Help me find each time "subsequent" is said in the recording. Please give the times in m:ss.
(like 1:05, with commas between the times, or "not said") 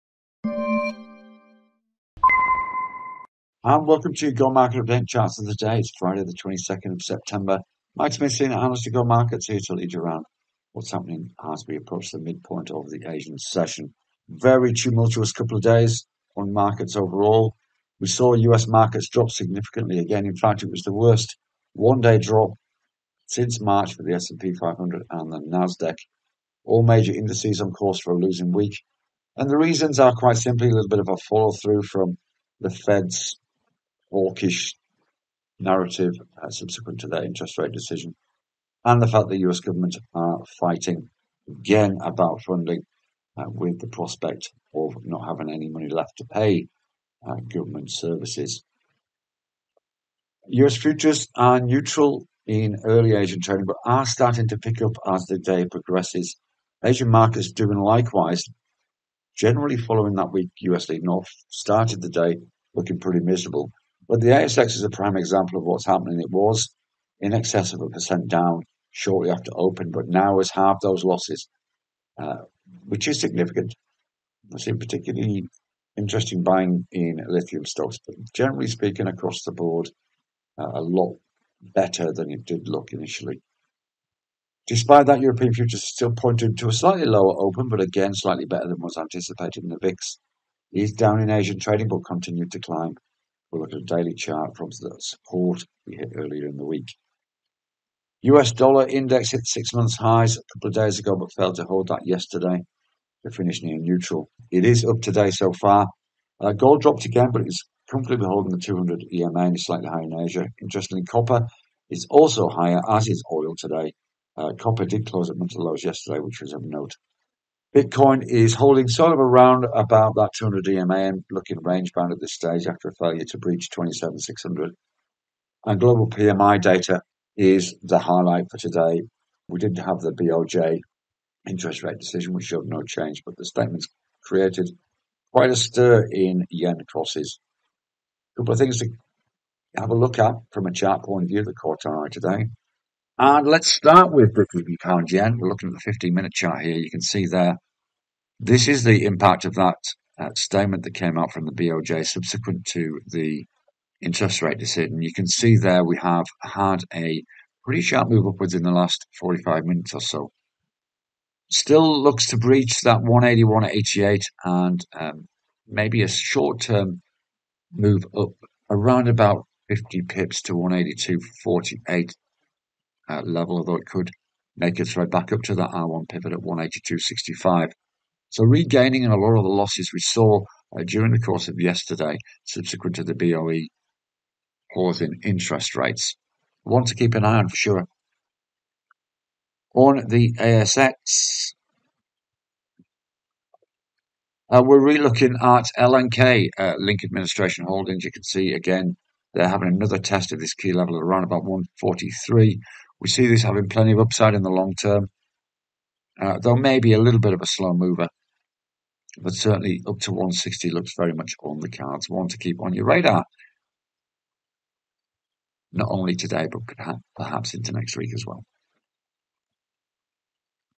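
0:36, 2:32, 3:02.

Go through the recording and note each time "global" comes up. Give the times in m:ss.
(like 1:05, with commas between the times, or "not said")
2:05.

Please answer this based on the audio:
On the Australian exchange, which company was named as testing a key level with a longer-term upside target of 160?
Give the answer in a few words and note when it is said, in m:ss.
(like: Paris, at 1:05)
Link Administration Holdings, at 3:16.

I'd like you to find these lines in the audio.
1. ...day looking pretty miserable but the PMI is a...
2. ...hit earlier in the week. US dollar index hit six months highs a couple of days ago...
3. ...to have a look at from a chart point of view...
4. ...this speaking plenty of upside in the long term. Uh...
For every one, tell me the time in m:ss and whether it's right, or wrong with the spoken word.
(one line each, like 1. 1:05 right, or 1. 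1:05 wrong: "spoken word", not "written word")
1. 1:02 wrong: "ASX", not "PMI"
2. 1:35 right
3. 2:18 right
4. 3:23 wrong: "having", not "speaking".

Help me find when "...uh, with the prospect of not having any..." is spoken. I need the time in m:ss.
0:43.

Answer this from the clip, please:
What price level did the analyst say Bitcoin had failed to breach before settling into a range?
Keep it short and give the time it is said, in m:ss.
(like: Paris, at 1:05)
27600, at 2:03.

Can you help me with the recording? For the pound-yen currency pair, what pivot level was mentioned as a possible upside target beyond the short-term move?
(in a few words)
182.65.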